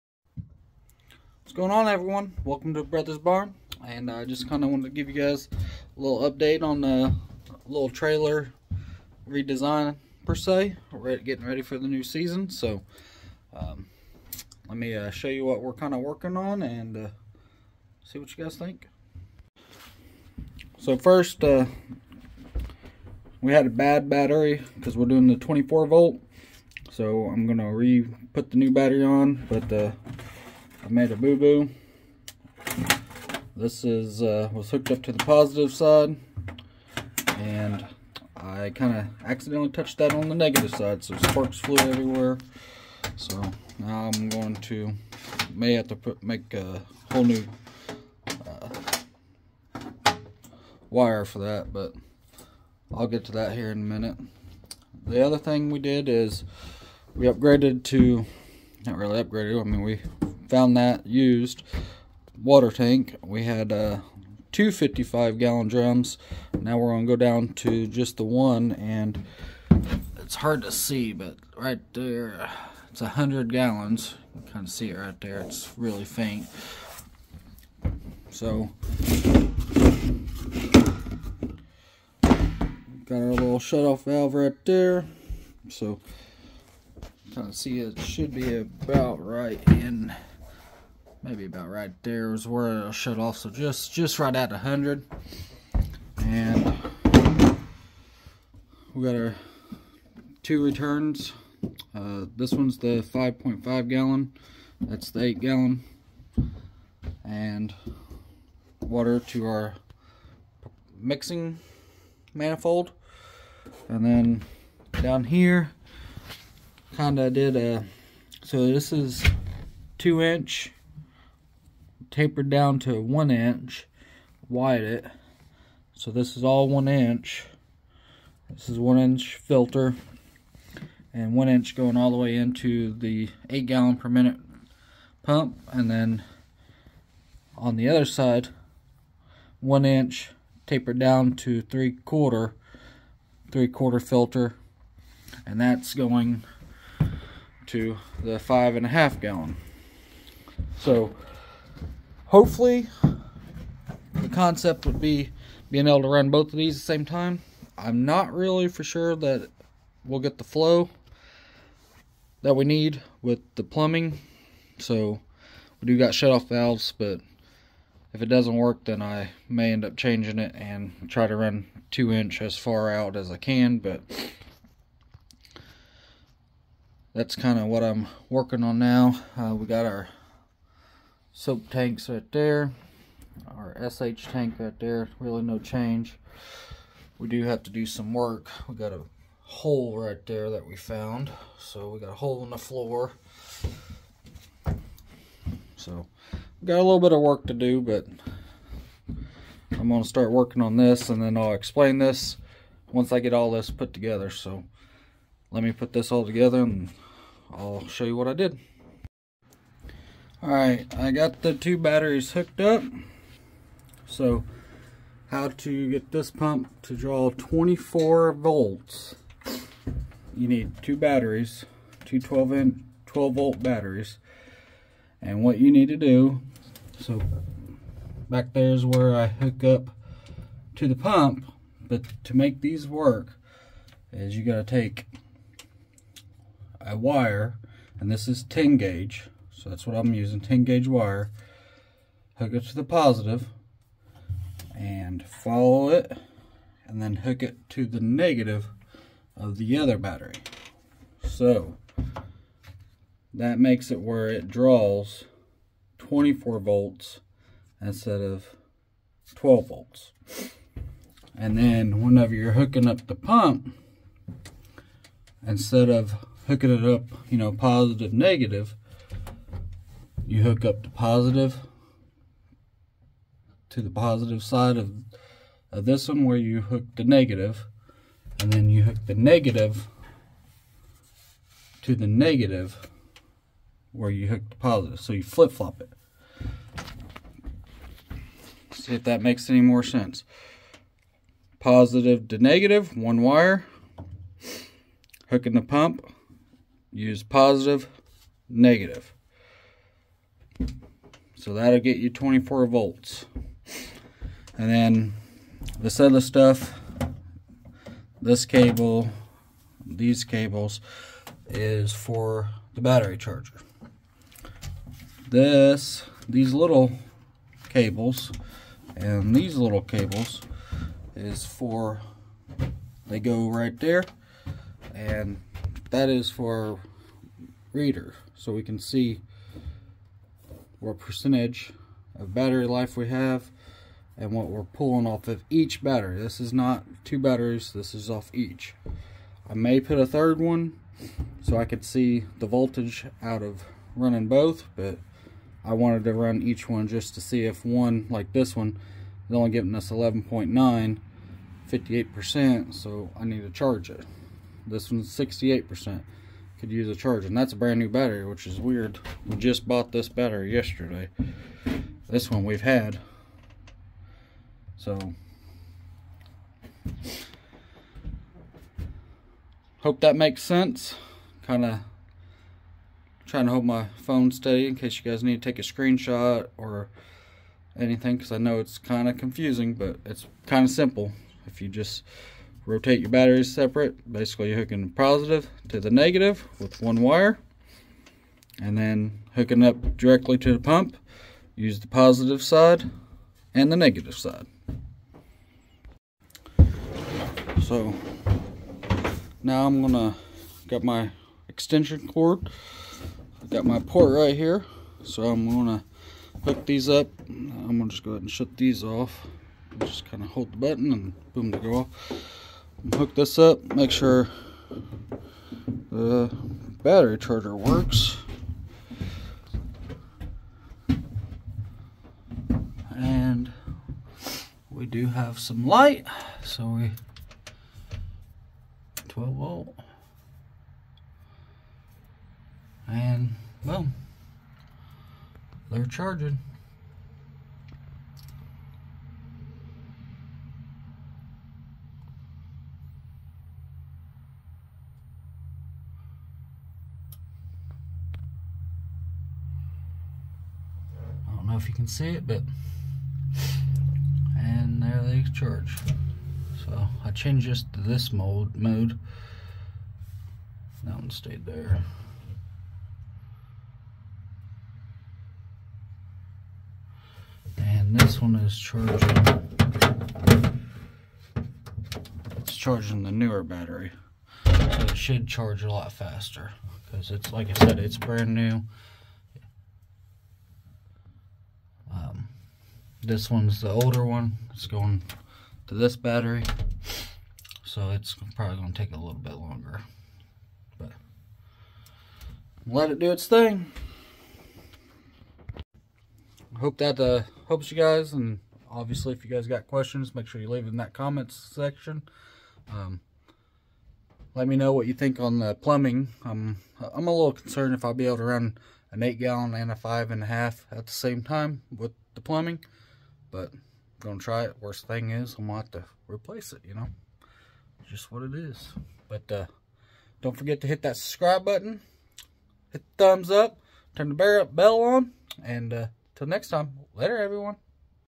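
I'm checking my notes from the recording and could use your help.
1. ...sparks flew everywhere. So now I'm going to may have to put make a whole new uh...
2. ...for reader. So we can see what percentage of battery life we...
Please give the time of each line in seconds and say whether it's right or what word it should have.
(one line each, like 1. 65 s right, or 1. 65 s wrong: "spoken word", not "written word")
1. 41 s right
2. 326 s right.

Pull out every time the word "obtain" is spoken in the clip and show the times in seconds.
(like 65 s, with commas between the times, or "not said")
not said.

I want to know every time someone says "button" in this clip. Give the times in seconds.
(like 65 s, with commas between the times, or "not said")
410 s, 521 s.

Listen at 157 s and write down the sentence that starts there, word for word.
I'm not really for sure that we'll get the flow that we need with the plumbing.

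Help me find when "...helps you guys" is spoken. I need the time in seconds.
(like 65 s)
497 s.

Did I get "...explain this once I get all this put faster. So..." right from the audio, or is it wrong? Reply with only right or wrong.
wrong.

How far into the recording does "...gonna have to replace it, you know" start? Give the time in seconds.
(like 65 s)
515 s.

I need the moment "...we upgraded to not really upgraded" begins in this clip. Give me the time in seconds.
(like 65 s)
57 s.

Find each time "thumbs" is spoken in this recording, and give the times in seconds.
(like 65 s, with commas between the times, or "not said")
523 s.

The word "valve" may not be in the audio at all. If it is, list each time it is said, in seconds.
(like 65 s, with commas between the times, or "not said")
84 s, 166 s.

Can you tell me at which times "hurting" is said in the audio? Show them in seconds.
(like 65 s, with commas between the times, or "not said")
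not said.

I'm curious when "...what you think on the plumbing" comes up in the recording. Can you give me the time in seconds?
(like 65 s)
504 s.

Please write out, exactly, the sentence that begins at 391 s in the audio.
Use the positive side and the negative side.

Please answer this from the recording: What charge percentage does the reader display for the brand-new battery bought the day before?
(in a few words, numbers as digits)
68%.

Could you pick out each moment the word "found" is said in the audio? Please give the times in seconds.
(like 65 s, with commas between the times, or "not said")
60 s, 190 s.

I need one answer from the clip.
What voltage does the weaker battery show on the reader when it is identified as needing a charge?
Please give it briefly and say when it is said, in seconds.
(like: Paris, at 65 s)
11.9, at 349 s.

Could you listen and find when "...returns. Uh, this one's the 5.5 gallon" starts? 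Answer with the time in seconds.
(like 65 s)
100 s.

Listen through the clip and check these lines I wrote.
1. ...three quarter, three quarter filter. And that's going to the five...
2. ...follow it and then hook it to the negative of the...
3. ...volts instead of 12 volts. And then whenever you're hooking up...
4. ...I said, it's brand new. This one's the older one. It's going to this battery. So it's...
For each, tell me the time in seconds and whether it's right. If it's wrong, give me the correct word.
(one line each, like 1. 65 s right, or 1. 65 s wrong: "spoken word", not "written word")
1. 141 s right
2. 245 s right
3. 256 s right
4. 477 s right.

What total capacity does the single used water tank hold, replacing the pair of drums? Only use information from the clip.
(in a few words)
100 gallons.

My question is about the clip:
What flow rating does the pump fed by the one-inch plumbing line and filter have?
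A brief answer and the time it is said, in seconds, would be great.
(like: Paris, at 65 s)
8 gallons per minute, at 133 s.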